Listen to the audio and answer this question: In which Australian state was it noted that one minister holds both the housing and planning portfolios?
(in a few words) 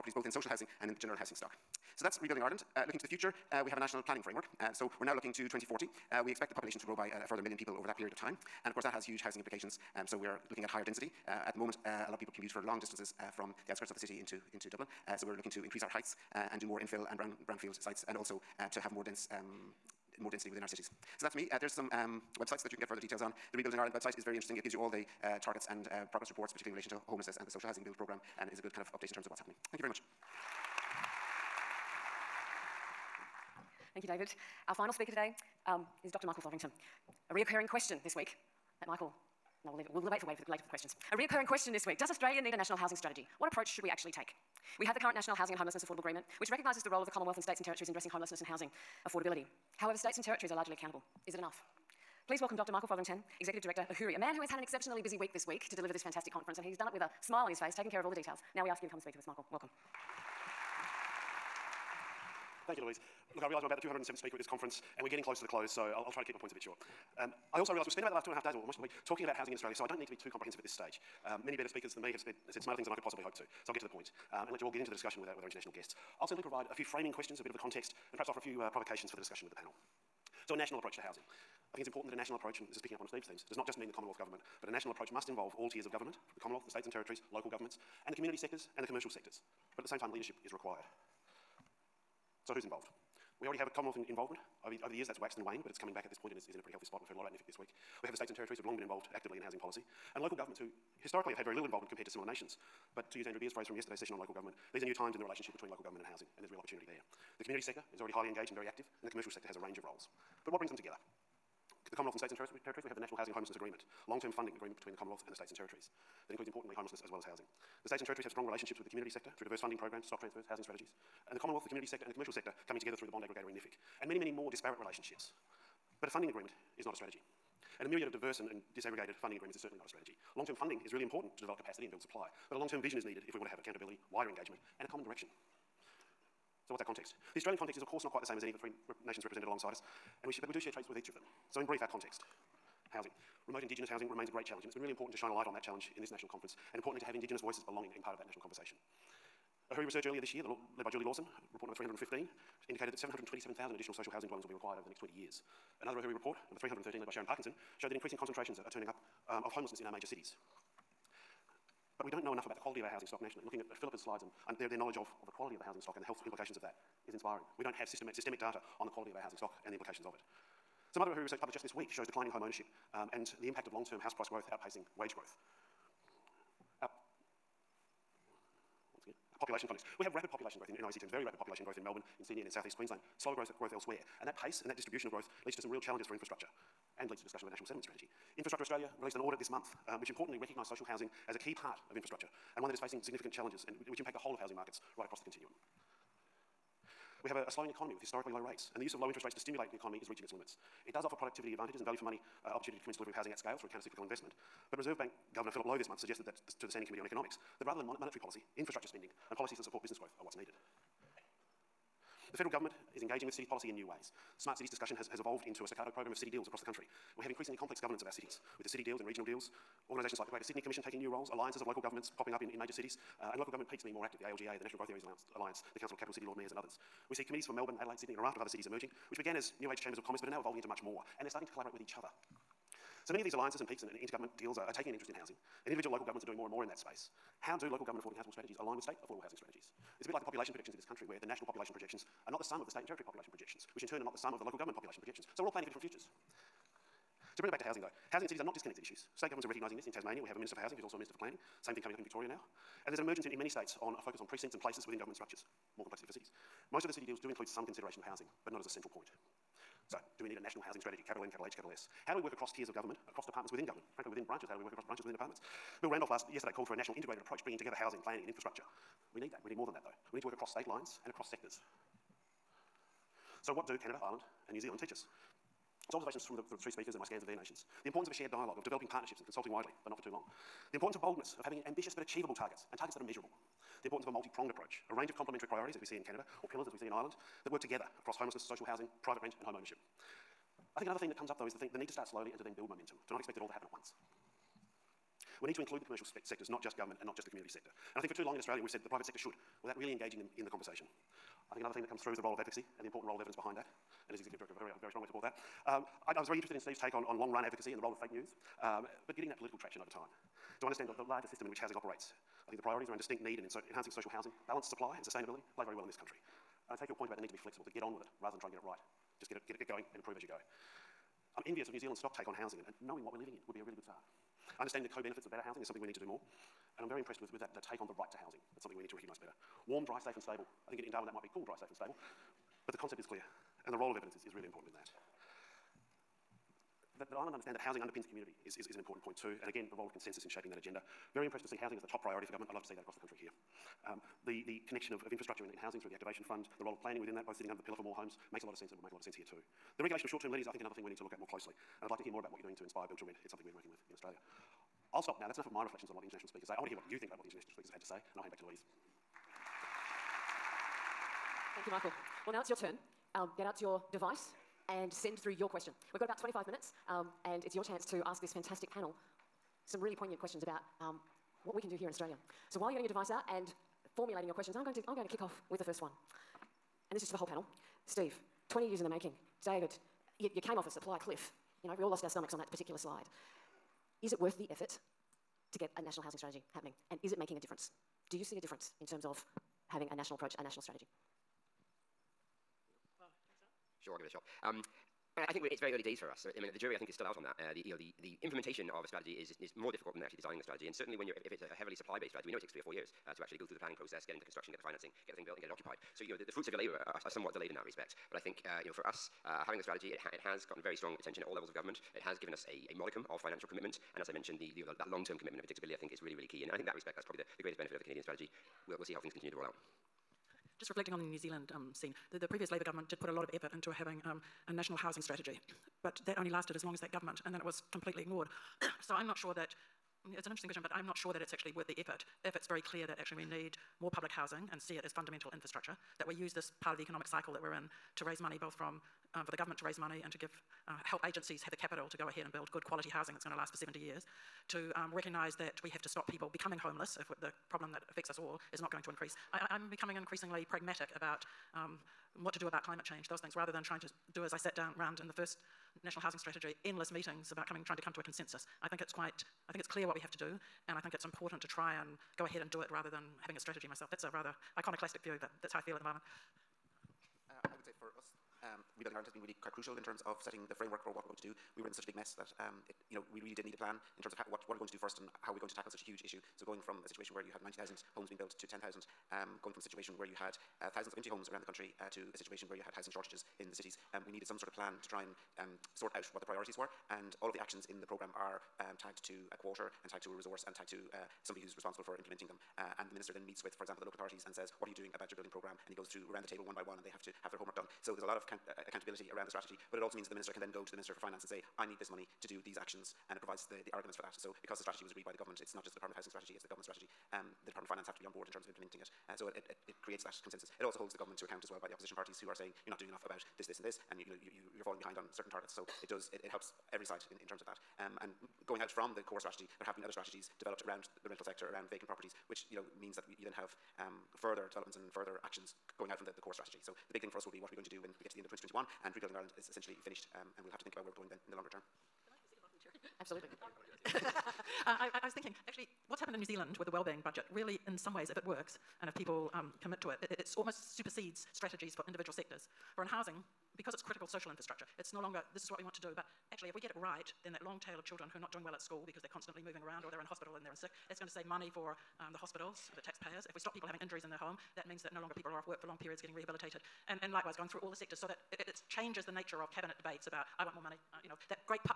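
Tasmania.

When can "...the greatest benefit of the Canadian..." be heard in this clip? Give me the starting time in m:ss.
6:57.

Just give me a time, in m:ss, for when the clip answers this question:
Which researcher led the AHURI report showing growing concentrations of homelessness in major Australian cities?
2:37.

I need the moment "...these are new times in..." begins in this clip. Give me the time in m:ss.
1:44.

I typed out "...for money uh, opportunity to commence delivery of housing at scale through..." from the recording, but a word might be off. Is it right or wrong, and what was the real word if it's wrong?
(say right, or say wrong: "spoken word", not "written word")
right.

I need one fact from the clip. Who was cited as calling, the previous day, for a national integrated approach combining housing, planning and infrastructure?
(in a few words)
Bill Randolph.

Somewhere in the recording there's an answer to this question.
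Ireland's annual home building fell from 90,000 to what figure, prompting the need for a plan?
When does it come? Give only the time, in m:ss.
7:58.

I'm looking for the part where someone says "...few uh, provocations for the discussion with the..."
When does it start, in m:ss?
1:18.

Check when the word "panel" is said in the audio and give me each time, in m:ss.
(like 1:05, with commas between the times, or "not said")
1:19, 6:08, 6:17.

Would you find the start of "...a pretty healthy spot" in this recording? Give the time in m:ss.
1:36.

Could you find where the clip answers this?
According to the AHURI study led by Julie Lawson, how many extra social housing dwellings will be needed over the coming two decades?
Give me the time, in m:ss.
2:32.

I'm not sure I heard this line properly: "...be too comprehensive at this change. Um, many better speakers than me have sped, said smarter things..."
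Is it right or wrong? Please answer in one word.
wrong.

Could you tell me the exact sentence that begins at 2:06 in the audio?
But a funding agreement is not a strategy.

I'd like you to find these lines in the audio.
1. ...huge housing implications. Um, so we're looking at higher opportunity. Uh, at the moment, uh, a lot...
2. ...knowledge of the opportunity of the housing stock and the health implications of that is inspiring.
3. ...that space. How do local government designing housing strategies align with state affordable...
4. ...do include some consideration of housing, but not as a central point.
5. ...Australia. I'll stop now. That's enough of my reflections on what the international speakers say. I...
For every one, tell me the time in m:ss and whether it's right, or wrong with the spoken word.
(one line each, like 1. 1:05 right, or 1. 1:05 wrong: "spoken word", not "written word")
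1. 0:09 wrong: "density", not "opportunity"
2. 2:44 wrong: "quality", not "opportunity"
3. 3:56 wrong: "affording", not "designing"
4. 4:17 right
5. 5:53 right.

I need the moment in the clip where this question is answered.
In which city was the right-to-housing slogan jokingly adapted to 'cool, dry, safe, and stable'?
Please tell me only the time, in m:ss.
5:30.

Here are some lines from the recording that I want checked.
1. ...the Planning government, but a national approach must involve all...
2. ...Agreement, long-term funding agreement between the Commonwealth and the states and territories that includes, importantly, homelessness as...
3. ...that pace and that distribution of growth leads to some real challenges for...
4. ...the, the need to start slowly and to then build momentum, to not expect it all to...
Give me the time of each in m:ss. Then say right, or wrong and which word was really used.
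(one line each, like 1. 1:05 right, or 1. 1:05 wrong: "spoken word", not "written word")
1. 1:23 wrong: "Commonwealth", not "Planning"
2. 1:53 right
3. 3:04 right
4. 4:51 right.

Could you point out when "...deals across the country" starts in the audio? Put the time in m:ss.
3:36.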